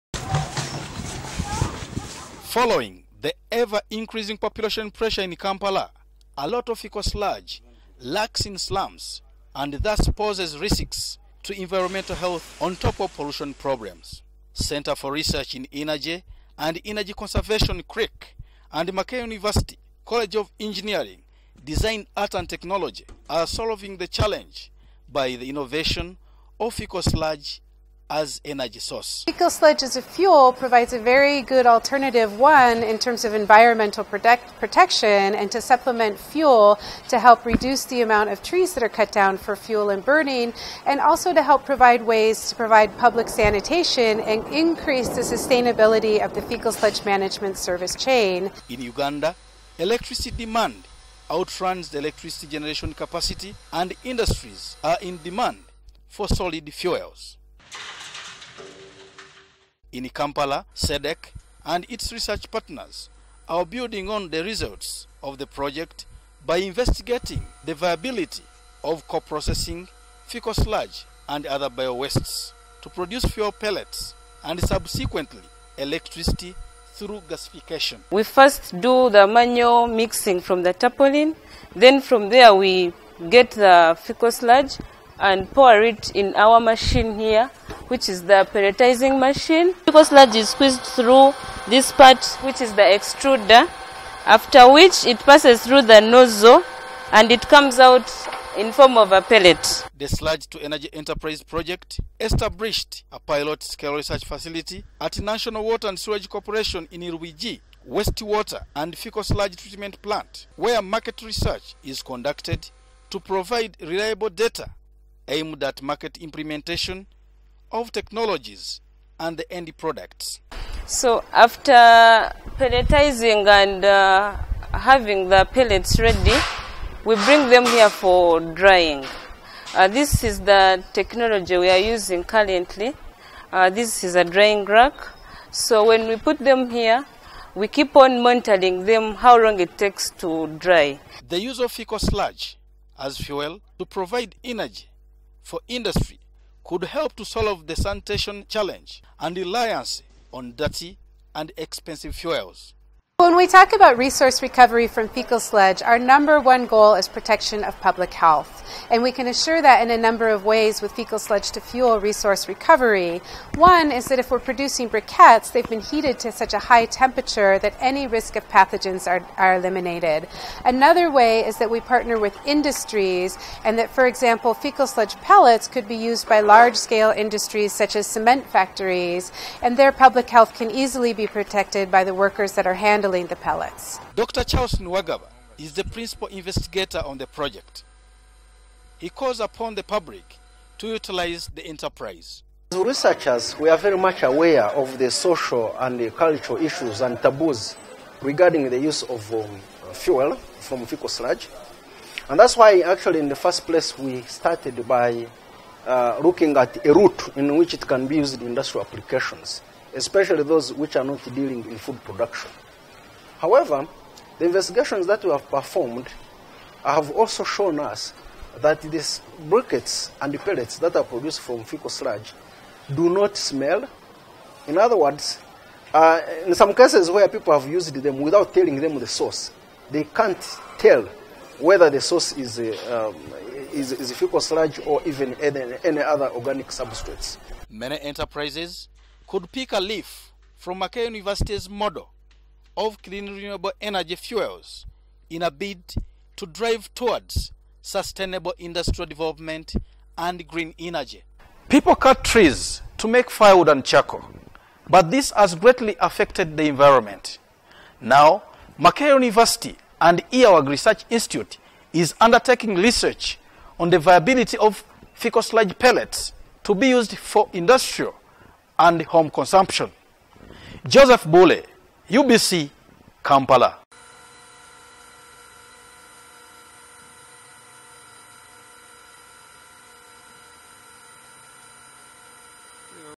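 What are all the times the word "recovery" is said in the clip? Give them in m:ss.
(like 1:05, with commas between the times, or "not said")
2:34, 2:42.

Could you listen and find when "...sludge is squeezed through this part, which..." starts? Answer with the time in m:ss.
1:30.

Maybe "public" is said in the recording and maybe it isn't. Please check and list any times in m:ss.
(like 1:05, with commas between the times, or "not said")
0:42, 2:37, 2:59, 3:09.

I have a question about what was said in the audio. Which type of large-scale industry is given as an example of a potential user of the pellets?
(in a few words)
Cement factories.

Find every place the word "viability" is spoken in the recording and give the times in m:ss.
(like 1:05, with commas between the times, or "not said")
1:07, 4:23.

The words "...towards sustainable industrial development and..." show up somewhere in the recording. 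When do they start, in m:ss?
4:06.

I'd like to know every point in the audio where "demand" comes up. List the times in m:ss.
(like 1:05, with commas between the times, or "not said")
0:50, 0:55.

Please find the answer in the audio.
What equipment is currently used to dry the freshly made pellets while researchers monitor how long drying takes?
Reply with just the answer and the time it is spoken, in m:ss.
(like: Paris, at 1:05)
Drying rack, at 2:14.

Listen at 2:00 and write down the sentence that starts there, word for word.
So after pelletizing and uh, having the pellets ready, we bring them here for drying.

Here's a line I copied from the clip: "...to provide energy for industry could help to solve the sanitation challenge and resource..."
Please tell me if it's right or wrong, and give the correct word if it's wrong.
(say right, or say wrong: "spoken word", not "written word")
wrong: "reliance", not "resource".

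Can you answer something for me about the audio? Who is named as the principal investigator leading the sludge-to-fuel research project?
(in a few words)
Dr. Charles Niwagaba.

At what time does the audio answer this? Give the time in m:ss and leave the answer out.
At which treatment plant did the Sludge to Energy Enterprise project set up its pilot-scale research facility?
1:47.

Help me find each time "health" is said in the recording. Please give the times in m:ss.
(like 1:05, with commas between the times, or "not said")
0:12, 2:38, 3:00.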